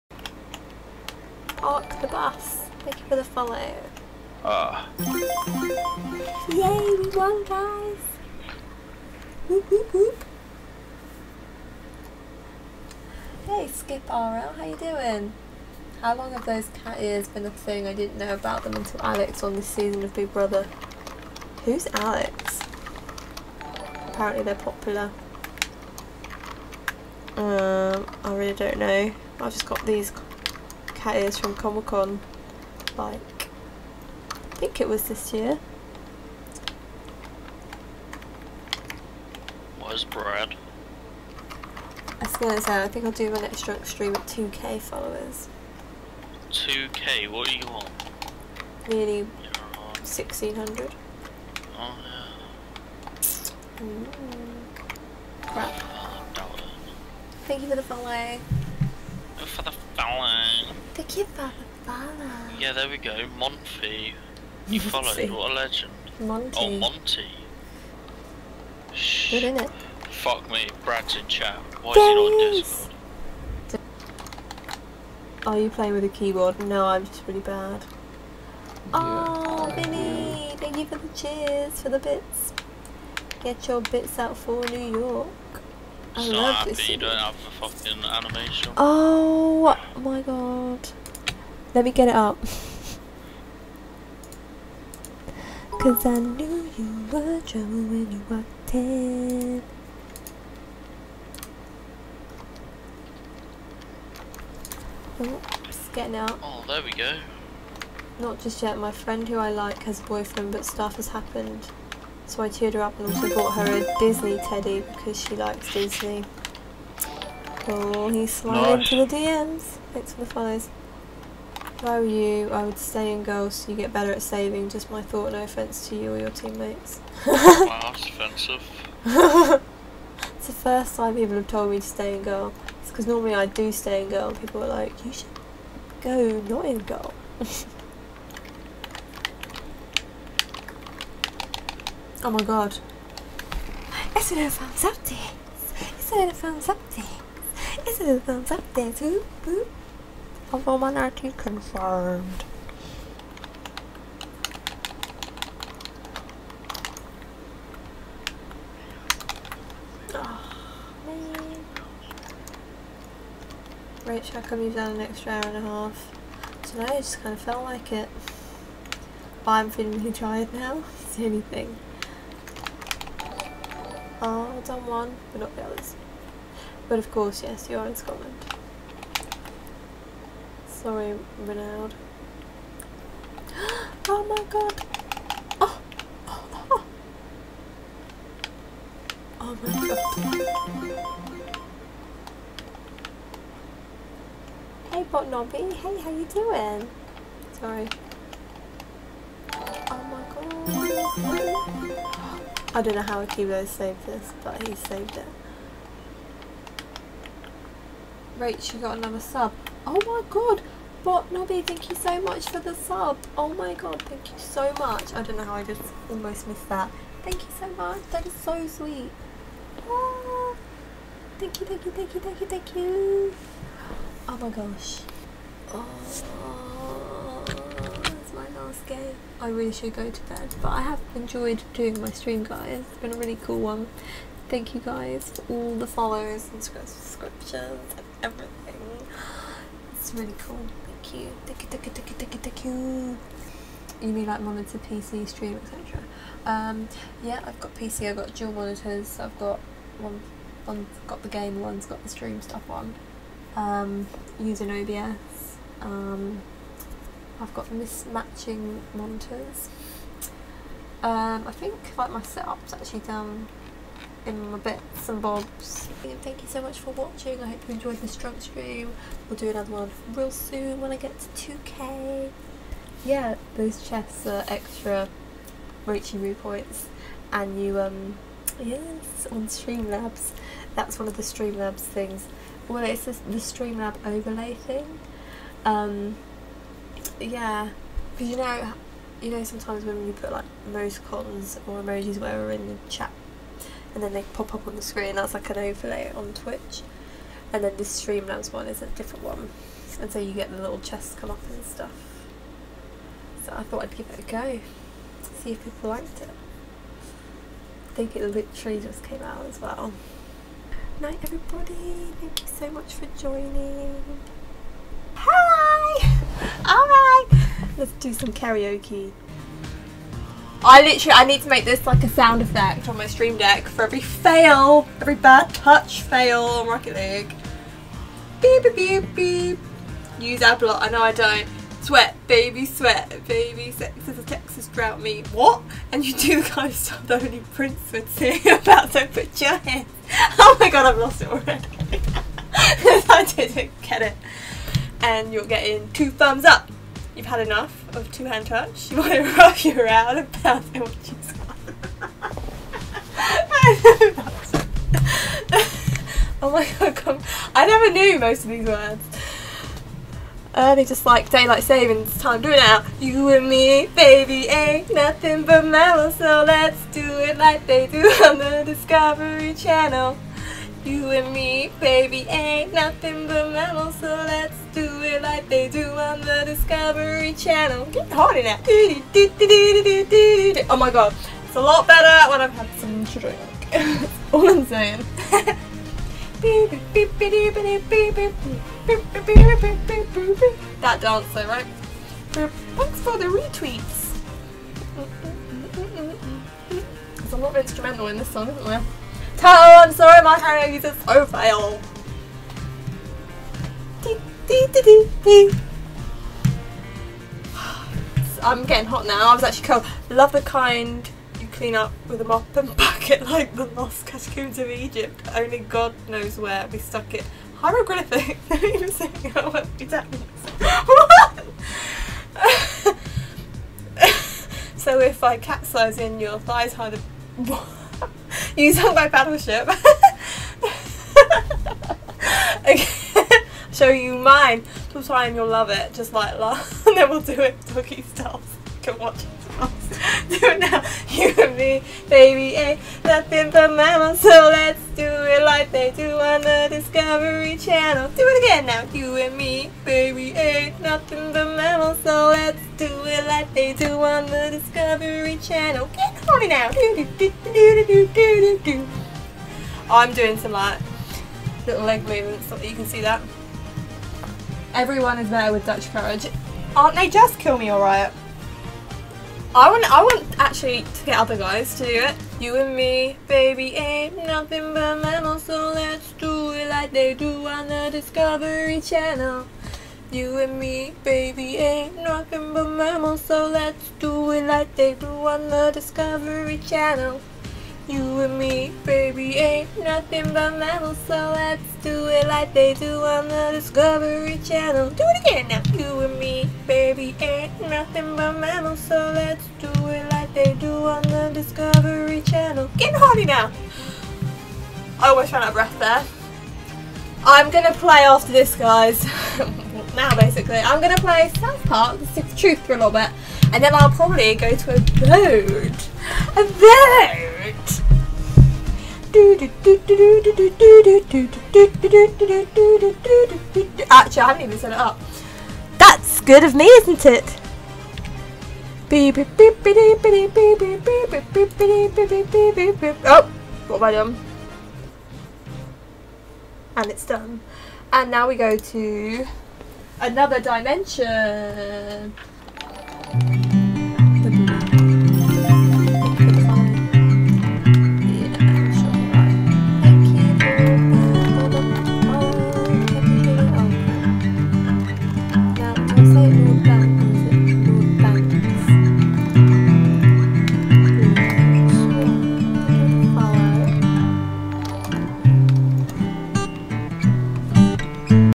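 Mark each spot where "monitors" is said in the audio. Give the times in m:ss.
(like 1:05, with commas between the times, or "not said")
4:04, 4:08, 4:18.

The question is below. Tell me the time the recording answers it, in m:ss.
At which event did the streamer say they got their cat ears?
0:31.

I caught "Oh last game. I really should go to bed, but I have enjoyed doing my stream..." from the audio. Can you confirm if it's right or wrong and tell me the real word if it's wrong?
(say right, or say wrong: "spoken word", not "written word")
right.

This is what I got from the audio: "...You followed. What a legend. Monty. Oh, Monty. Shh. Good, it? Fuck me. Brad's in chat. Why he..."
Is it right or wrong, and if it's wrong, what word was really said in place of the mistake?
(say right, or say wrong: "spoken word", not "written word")
right.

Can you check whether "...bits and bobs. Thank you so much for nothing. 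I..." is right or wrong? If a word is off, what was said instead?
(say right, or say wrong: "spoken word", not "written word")
wrong: "watching", not "nothing".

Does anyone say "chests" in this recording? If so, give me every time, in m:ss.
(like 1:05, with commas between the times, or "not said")
4:33, 5:00.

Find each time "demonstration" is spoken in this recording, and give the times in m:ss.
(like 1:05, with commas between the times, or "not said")
not said.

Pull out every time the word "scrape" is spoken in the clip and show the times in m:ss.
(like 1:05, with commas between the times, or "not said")
not said.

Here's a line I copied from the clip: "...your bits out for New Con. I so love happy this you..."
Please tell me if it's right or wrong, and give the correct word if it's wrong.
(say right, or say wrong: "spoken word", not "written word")
wrong: "York", not "Con".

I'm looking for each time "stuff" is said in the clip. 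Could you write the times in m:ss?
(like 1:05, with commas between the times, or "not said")
1:50, 4:12, 5:01, 5:36.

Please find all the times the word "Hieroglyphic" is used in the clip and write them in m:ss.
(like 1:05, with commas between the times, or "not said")
6:57.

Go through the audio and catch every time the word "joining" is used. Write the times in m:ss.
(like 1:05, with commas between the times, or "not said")
5:13.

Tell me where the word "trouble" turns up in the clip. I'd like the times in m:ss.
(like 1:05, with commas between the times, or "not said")
1:37.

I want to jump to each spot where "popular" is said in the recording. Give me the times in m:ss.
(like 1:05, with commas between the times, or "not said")
0:24.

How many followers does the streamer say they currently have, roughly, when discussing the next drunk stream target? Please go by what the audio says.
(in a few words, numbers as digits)
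Nearly 1600.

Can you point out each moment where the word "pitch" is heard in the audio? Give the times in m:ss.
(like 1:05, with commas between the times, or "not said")
not said.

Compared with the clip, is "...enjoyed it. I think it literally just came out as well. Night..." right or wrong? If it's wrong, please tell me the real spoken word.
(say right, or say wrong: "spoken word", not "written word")
wrong: "liked", not "enjoyed".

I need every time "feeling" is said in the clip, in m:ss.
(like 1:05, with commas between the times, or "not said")
2:49.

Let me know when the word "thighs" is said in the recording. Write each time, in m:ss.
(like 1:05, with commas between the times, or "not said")
7:06.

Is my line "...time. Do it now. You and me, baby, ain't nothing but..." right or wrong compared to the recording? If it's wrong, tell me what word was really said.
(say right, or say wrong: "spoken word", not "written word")
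right.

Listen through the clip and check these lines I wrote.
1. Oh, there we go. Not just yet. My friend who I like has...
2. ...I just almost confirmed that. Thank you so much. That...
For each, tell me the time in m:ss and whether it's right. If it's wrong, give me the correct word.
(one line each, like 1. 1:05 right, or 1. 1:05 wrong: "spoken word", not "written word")
1. 1:46 right
2. 3:35 wrong: "missed", not "confirmed".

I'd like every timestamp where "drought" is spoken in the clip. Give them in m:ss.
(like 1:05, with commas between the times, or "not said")
5:34.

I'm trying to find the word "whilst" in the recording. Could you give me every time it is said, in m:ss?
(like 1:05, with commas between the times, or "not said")
not said.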